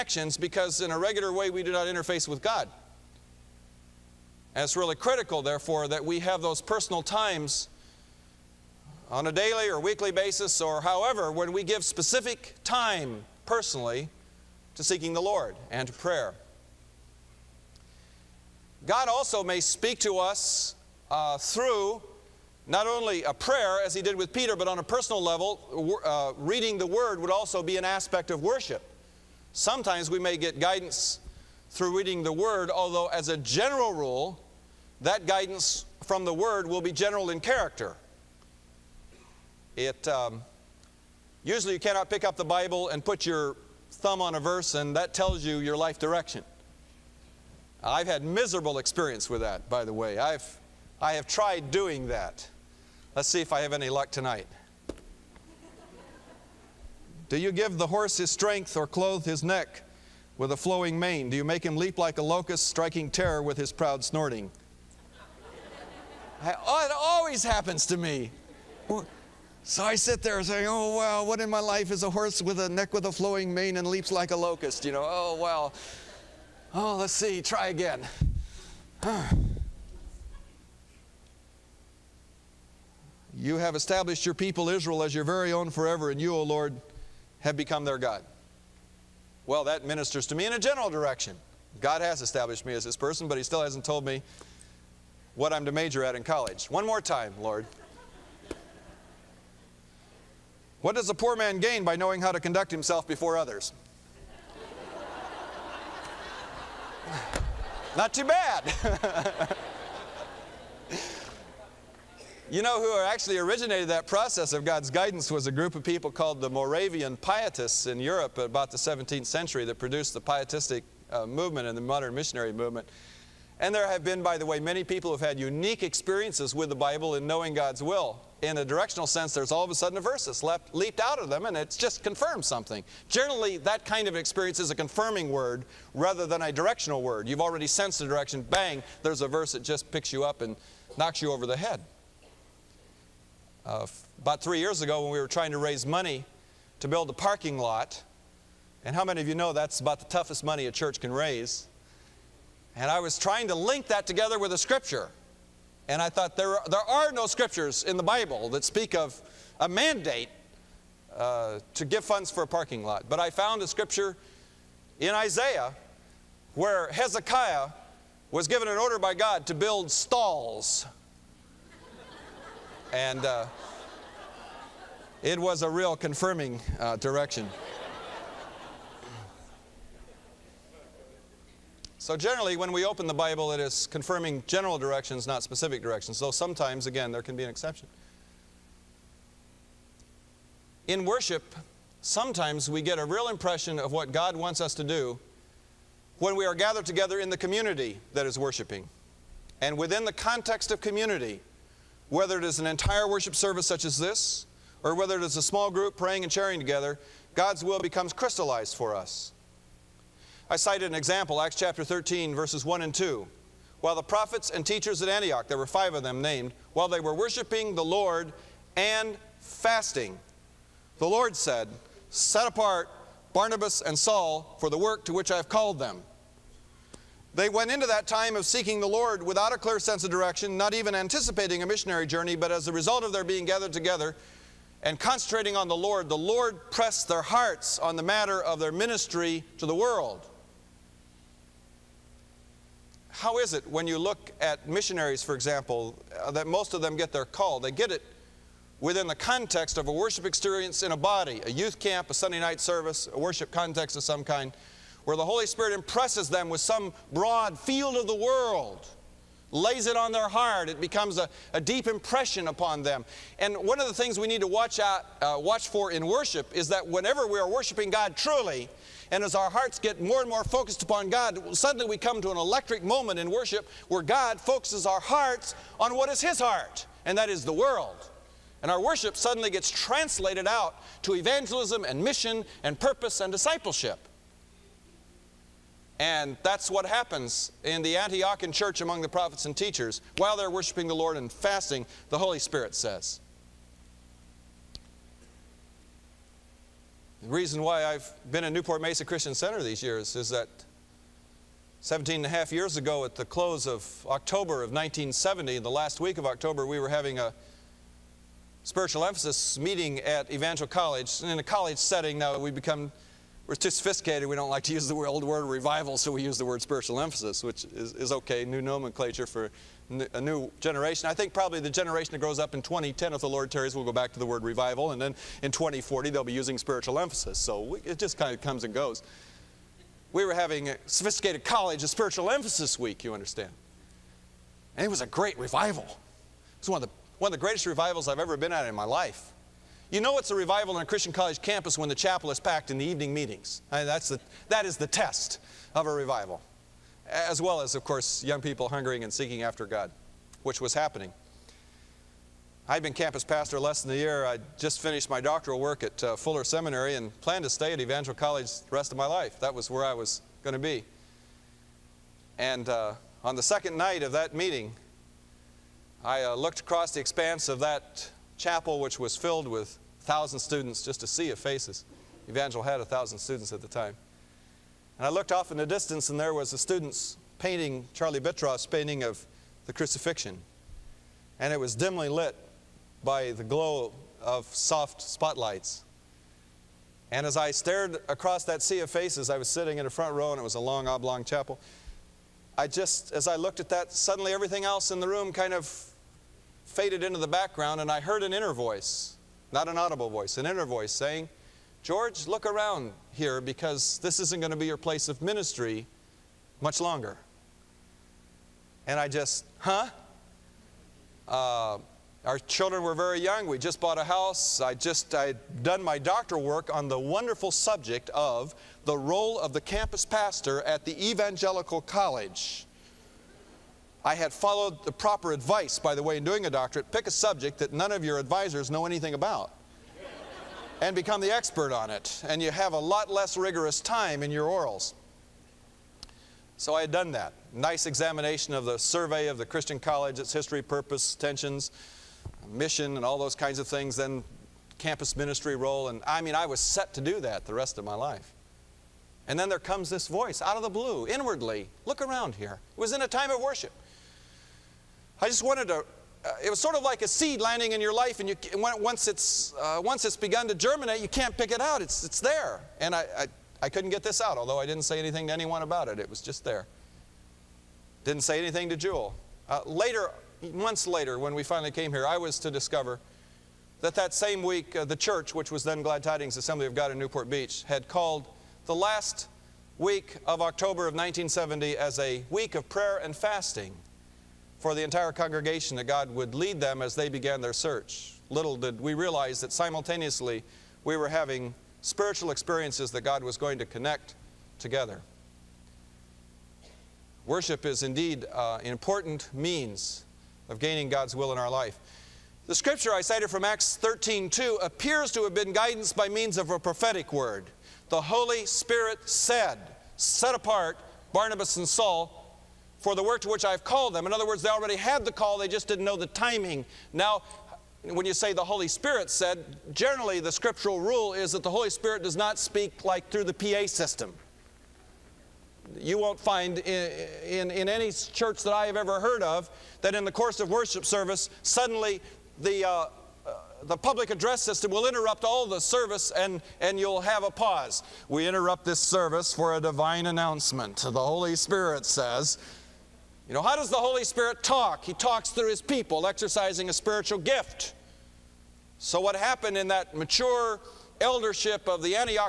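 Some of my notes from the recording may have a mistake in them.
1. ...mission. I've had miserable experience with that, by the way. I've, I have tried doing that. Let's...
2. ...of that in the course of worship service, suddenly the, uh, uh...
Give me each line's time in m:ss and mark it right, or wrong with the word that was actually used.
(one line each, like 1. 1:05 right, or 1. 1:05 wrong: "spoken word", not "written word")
1. 0:45 wrong: "direction", not "mission"
2. 8:49 right.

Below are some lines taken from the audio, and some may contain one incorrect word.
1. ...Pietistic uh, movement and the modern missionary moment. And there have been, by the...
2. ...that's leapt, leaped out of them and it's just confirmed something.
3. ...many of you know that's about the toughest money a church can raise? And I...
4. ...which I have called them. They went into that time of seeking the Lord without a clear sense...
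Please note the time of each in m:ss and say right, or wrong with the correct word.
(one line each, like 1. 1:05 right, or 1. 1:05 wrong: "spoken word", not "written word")
1. 2:00 wrong: "movement", not "moment"
2. 2:10 right
3. 2:29 right
4. 3:45 right.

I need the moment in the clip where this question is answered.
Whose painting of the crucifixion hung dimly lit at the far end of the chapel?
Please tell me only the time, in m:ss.
6:17.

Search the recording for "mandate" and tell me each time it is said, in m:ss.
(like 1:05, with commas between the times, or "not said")
2:39.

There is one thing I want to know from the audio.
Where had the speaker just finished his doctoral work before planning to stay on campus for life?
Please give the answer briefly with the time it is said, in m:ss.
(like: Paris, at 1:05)
Fuller Seminary, at 5:56.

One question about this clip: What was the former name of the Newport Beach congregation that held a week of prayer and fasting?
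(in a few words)
Glad Tidings Assembly of God.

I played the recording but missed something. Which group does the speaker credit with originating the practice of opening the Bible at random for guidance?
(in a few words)
Moravian Pietists.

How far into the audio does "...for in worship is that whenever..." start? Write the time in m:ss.
4:25.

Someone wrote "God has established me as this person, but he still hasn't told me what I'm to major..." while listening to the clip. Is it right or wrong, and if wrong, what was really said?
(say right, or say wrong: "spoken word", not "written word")
right.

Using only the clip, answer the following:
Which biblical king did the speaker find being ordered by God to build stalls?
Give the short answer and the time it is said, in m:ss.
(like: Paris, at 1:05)
Hezekiah, at 2:46.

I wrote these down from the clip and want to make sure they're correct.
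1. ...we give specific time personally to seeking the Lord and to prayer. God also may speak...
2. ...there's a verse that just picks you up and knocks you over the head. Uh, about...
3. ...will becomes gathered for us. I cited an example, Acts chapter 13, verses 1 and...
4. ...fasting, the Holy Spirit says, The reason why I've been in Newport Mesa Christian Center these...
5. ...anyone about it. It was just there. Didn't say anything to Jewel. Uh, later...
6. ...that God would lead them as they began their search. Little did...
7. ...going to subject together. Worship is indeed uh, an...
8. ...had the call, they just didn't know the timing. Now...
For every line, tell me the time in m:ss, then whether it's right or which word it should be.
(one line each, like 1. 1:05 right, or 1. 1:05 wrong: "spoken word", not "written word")
1. 0:11 right
2. 2:19 right
3. 3:27 wrong: "crystallized", not "gathered"
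4. 4:51 right
5. 7:45 right
6. 8:05 right
7. 8:13 wrong: "connect", not "subject"
8. 8:34 right.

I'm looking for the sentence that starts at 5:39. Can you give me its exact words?
You know it's a revival on a Christian college campus when the chapel is packed in the evening meetings.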